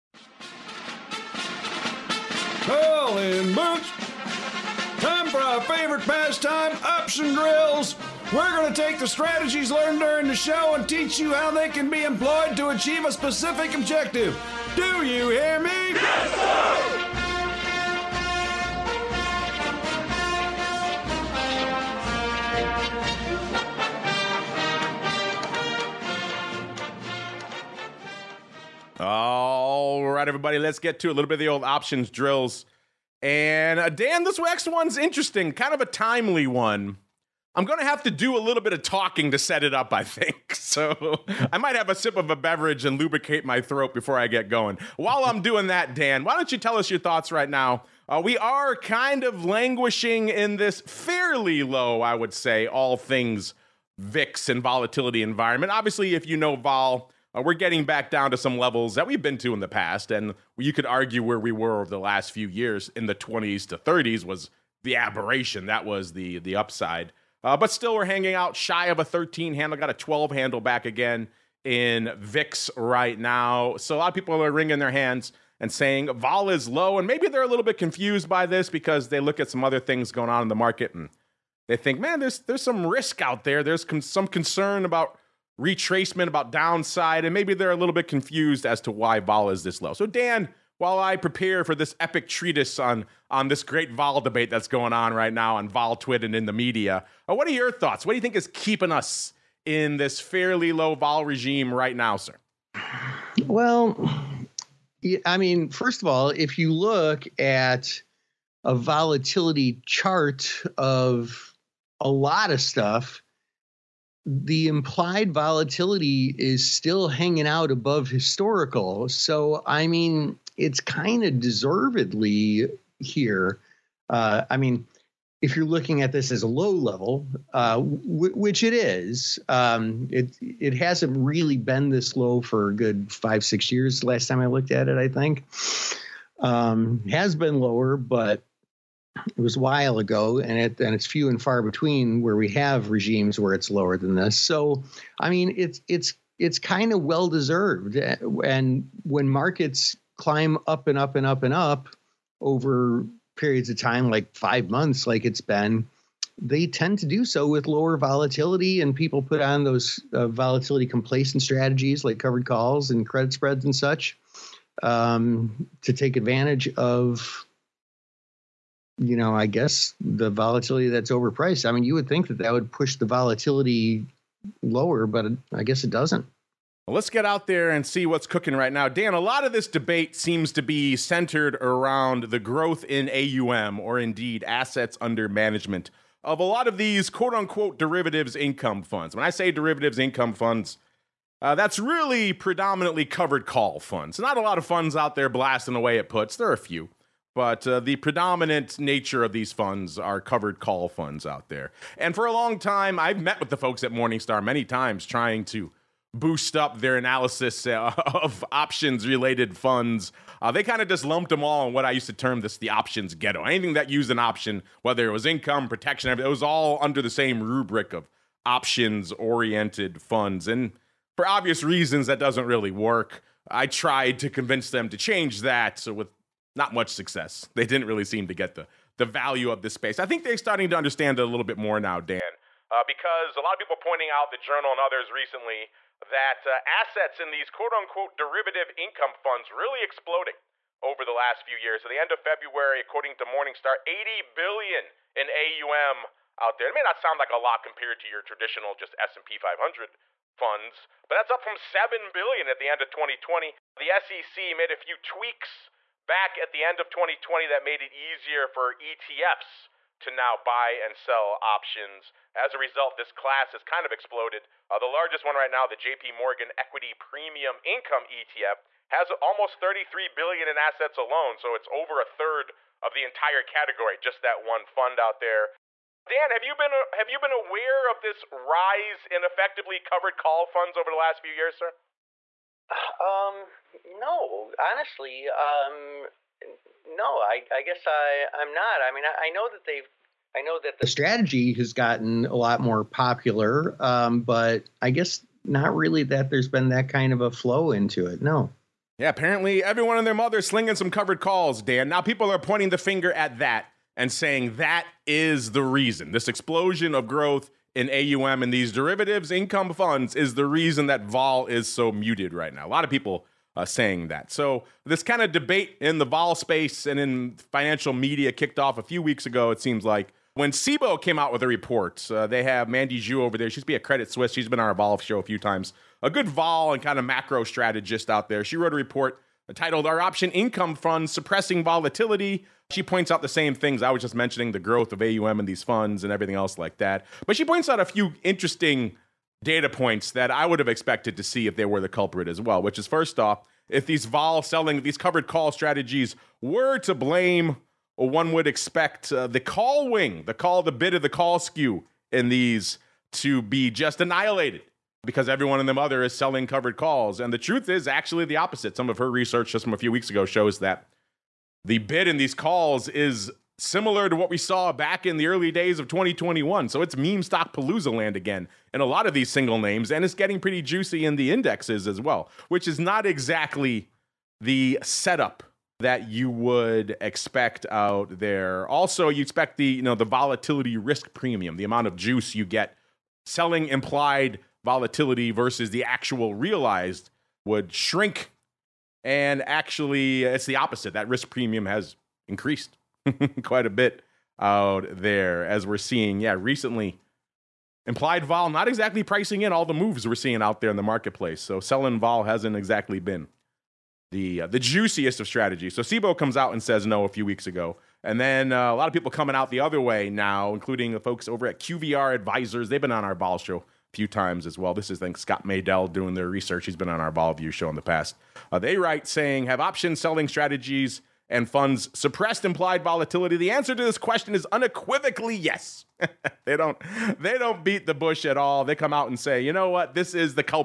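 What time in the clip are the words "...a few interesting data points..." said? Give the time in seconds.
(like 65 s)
337 s.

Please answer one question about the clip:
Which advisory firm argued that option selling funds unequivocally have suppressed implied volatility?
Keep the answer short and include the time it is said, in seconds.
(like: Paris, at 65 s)
QVR Advisors, at 411 s.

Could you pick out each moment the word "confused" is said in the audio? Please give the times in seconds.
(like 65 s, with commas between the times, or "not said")
77 s, 88 s.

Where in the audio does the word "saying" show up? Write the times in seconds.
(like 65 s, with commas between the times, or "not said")
75 s, 304 s, 313 s, 419 s.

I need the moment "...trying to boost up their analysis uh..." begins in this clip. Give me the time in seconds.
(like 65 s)
205 s.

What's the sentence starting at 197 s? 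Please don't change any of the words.
But uh, the predominant nature of these funds are covered call funds out there.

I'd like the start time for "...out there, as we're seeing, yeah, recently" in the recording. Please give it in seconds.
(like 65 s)
394 s.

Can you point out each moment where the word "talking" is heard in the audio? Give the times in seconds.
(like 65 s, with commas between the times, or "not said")
38 s.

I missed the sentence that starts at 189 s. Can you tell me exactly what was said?
When I say derivatives income funds, uh, that's really predominantly covered call funds.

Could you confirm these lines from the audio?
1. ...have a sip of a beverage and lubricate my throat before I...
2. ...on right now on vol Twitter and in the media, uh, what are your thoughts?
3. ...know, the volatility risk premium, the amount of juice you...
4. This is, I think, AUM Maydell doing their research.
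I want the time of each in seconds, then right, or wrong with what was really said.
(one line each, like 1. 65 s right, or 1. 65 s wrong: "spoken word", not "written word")
1. 41 s right
2. 94 s right
3. 379 s right
4. 414 s wrong: "Scott", not "AUM".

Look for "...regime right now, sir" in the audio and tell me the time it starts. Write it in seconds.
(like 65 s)
101 s.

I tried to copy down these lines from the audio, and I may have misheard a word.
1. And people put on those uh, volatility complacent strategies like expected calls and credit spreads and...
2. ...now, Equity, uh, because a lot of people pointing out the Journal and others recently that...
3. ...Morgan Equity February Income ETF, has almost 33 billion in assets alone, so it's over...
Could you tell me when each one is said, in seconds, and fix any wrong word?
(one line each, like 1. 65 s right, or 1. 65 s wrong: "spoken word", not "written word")
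1. 158 s wrong: "covered", not "expected"
2. 231 s wrong: "Dan", not "Equity"
3. 266 s wrong: "Premium", not "February".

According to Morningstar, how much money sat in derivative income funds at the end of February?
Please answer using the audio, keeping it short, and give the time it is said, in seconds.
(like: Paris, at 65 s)
$80 billion, at 243 s.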